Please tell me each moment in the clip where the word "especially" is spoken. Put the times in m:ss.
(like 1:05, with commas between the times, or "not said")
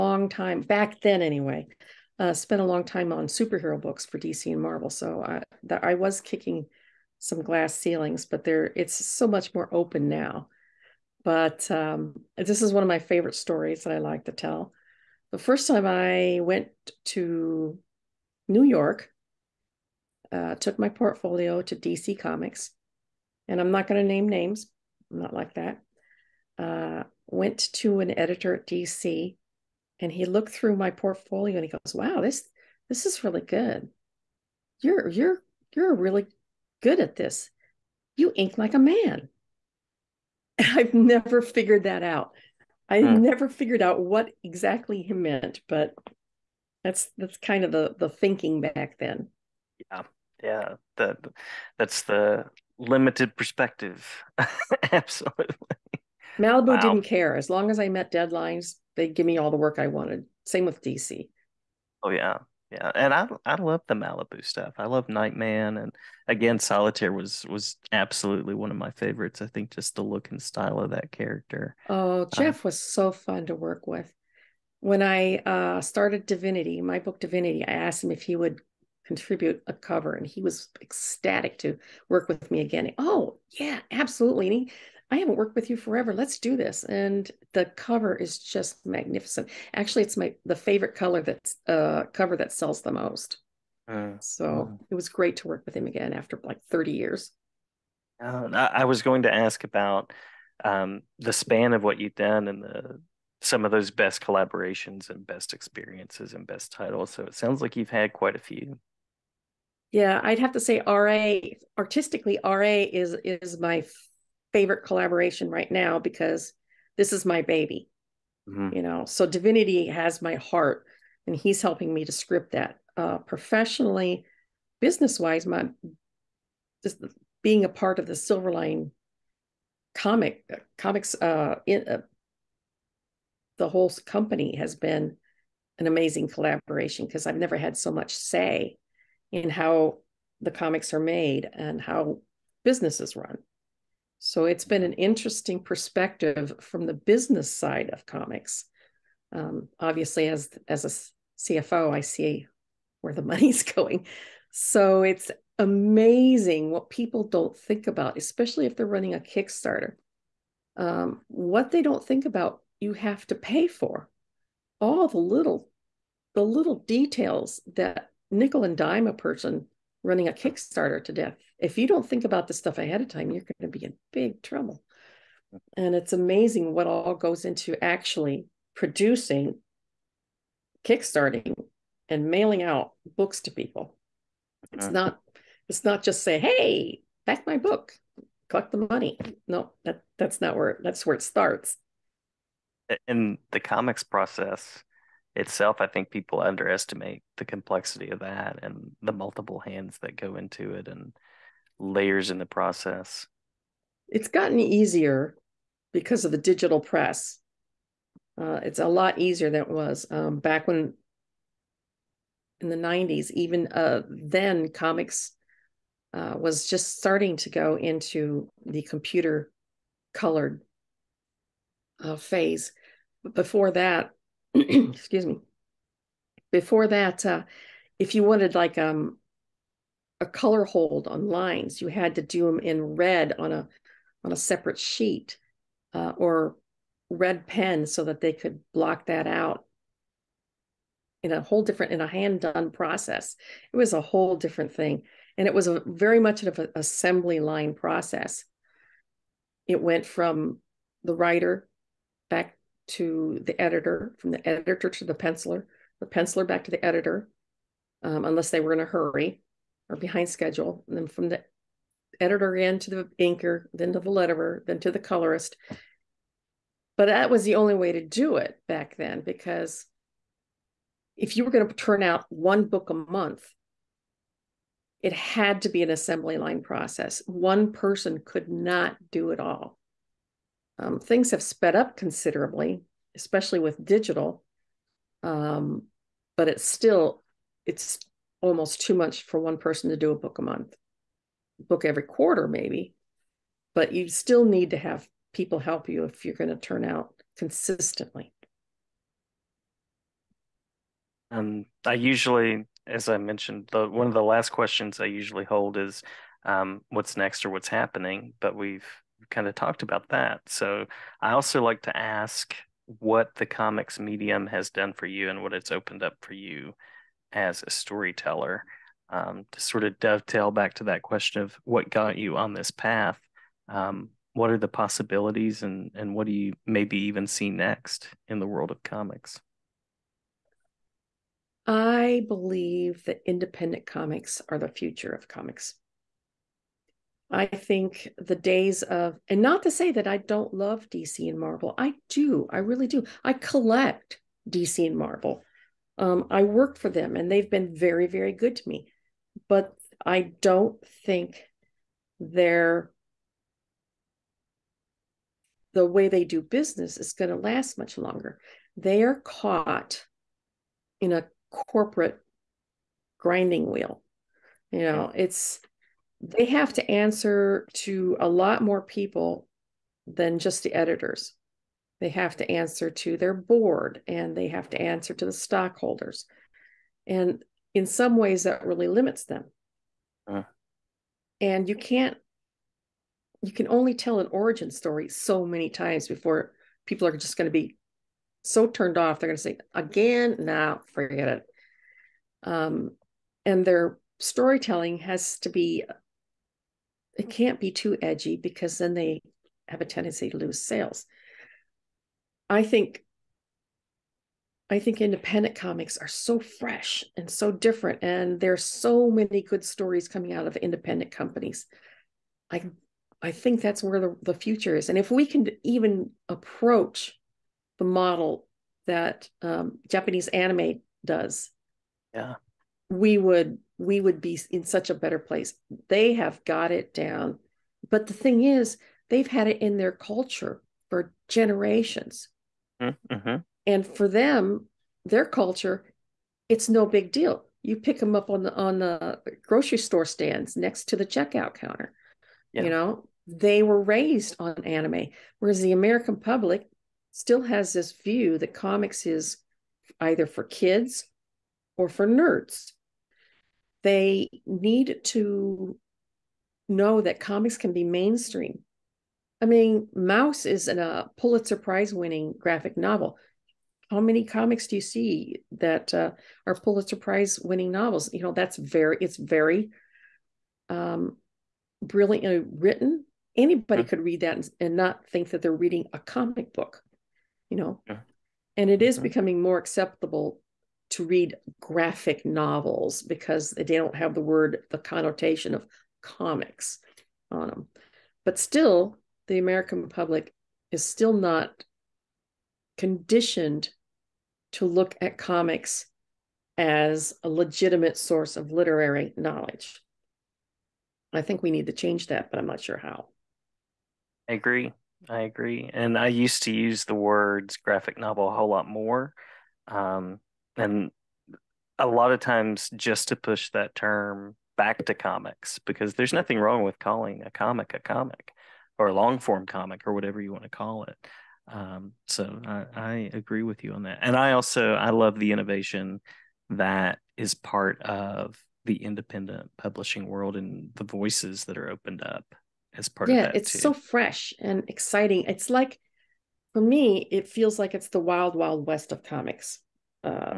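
2:38, 4:43.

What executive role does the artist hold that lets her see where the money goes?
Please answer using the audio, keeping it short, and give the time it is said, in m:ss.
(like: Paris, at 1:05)
CFO, at 2:31.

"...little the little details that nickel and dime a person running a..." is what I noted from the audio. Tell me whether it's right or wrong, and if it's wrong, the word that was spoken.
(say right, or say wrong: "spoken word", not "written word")
right.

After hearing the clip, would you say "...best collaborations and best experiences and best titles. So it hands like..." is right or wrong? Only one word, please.
wrong.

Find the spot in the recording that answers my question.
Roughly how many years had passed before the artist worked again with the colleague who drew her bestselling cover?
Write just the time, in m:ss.
1:36.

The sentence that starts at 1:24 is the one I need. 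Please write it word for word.
And he, I haven't worked with you forever.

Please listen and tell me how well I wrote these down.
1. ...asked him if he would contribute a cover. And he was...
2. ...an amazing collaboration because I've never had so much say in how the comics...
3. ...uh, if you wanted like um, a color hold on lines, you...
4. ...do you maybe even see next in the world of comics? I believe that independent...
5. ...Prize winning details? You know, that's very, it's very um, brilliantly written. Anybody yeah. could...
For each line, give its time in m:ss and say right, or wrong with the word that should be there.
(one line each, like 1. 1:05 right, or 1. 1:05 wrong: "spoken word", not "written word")
1. 1:17 right
2. 2:15 right
3. 3:47 right
4. 5:26 right
5. 7:46 wrong: "novels", not "details".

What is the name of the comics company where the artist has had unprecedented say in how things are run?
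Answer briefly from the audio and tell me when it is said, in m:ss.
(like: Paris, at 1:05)
Silverline, at 2:08.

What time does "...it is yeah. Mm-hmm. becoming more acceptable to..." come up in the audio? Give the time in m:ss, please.
7:58.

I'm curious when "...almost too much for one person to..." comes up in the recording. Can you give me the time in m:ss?
4:48.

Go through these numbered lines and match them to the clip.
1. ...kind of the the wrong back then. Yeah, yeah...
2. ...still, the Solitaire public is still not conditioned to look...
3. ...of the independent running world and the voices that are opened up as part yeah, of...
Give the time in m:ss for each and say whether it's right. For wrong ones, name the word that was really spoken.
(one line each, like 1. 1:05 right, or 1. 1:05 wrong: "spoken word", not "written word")
1. 0:47 wrong: "thinking", not "wrong"
2. 8:08 wrong: "American", not "Solitaire"
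3. 8:47 wrong: "publishing", not "running".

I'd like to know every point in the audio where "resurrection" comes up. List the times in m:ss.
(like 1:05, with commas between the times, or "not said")
not said.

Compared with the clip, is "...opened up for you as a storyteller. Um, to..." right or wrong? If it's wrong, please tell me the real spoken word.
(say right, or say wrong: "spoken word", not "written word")
right.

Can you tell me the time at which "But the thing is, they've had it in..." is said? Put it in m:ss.
7:07.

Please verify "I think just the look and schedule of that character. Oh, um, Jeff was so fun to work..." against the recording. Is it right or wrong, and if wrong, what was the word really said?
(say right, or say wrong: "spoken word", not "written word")
wrong: "style", not "schedule".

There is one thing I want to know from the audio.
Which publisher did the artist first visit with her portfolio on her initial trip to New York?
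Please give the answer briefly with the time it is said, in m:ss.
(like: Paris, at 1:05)
DC Comics, at 0:21.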